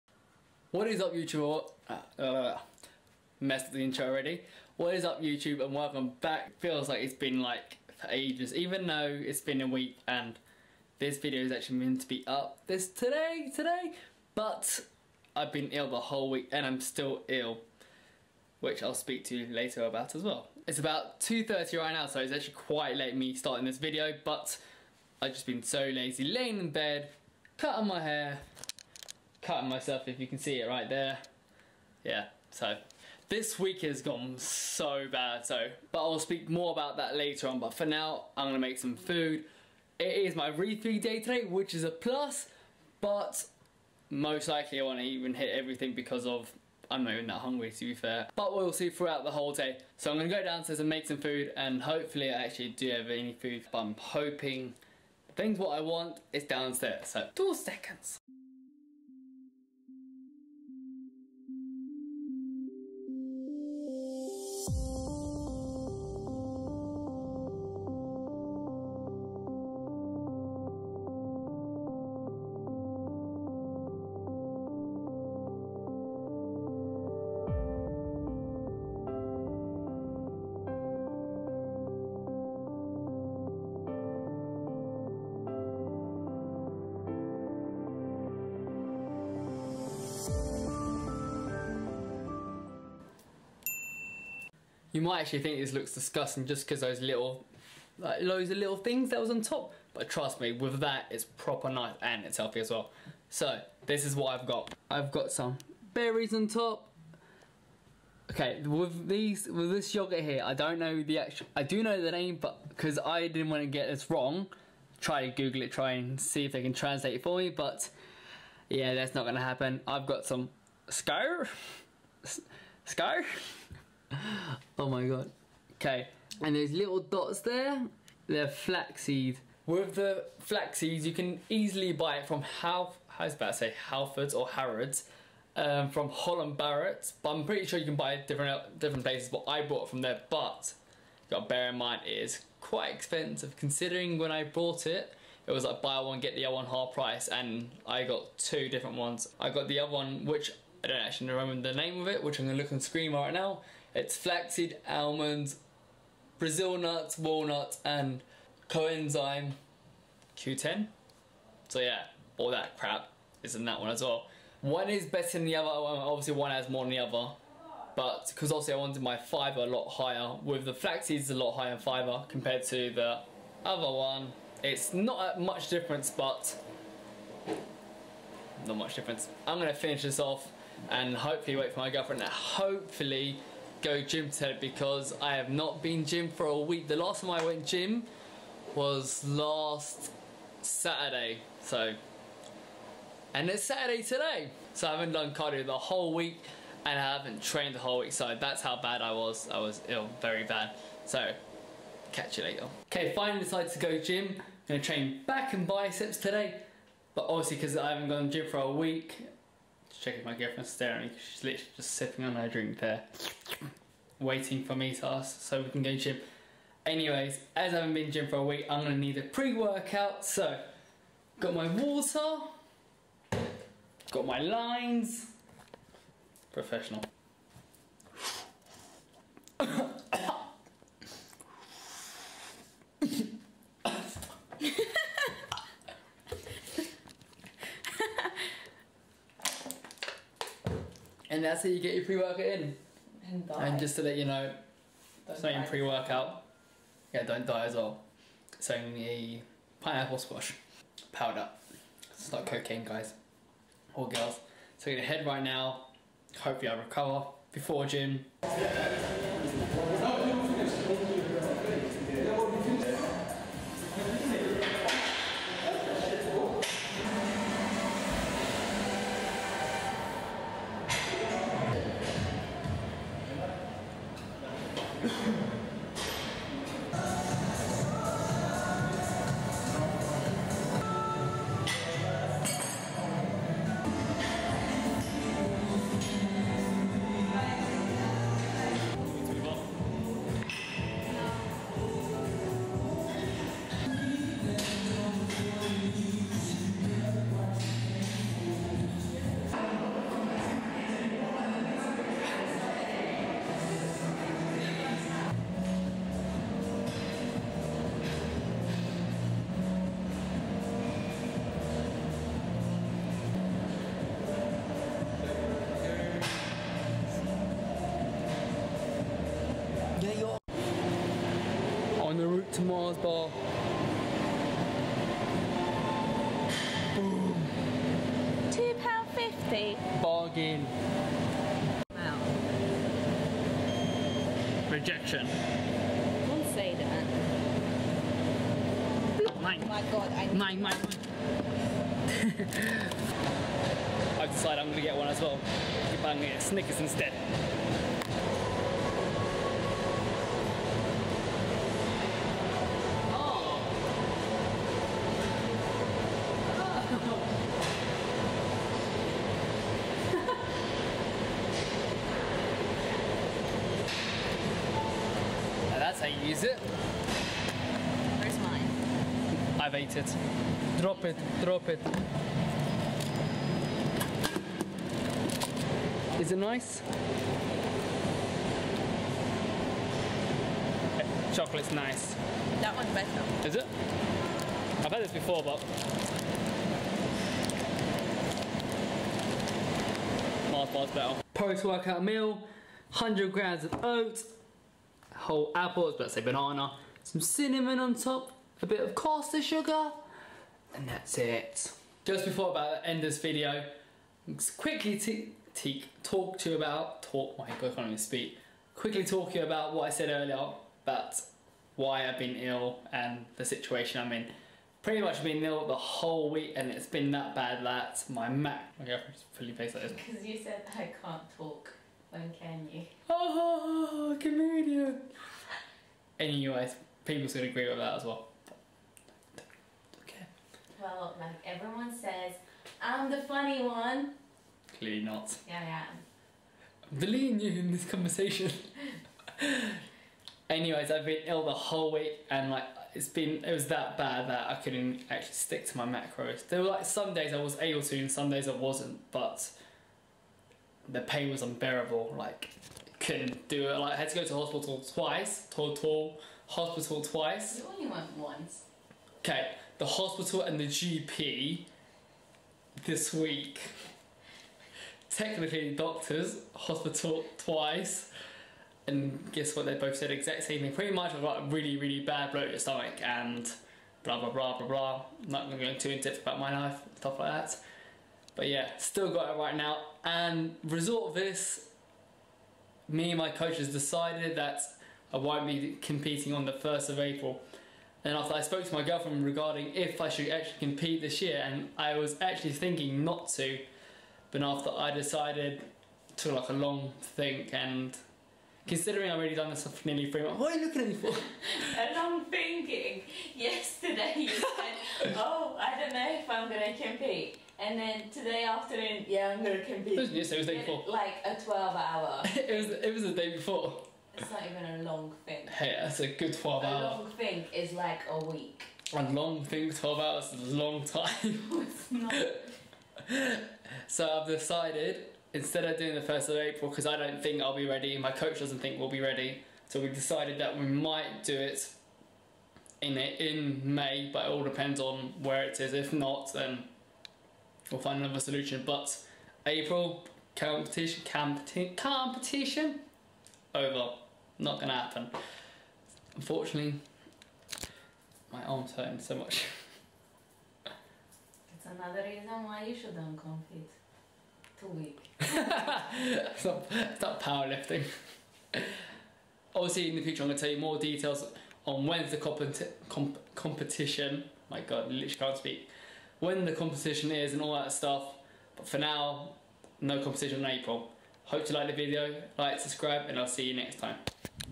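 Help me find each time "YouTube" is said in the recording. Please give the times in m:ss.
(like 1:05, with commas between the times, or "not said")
0:01, 0:05.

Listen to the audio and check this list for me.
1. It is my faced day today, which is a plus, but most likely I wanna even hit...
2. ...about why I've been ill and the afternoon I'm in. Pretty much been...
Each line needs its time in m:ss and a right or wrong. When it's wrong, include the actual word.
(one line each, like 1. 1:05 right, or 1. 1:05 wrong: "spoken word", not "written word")
1. 0:39 wrong: "refeed", not "faced"
2. 6:50 wrong: "situation", not "afternoon".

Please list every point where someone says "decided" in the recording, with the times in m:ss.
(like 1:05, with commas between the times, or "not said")
3:23, 5:44, 8:03, 8:14, 8:44, 8:49.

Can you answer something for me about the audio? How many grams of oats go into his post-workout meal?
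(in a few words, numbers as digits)
100.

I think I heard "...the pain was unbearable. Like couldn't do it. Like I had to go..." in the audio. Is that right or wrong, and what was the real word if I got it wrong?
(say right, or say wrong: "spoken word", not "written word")
right.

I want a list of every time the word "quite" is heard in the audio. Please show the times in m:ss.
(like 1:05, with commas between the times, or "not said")
0:22, 2:22.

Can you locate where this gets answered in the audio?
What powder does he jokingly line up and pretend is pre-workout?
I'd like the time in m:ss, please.
4:09.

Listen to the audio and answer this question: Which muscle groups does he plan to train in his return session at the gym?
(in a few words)
Back and biceps.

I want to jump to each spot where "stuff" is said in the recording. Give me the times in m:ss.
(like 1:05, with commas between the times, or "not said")
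7:56, 9:27.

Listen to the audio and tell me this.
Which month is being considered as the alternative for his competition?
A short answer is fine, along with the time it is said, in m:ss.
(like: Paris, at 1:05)
May, at 8:53.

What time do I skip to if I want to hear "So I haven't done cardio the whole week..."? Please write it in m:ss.
3:14.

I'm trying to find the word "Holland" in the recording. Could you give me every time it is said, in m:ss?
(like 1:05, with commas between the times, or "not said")
2:16.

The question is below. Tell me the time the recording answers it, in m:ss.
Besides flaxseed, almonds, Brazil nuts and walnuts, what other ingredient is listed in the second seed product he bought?
2:38.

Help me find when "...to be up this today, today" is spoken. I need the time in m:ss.
0:12.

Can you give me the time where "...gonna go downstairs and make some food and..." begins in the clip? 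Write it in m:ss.
0:50.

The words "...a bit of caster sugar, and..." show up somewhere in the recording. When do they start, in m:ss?
6:38.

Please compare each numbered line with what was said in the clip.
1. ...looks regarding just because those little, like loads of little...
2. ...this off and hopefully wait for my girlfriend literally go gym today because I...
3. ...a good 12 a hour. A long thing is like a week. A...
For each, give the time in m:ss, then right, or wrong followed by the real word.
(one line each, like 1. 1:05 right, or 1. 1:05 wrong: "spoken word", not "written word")
1. 1:35 wrong: "disgusting", not "regarding"
2. 3:00 wrong: "hopefully", not "literally"
3. 8:35 right.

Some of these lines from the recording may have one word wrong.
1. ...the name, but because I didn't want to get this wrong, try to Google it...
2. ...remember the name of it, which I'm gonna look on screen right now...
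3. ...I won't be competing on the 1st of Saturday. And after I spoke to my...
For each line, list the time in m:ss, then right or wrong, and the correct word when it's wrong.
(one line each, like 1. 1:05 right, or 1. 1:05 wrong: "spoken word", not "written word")
1. 1:52 right
2. 2:31 right
3. 8:05 wrong: "April", not "Saturday".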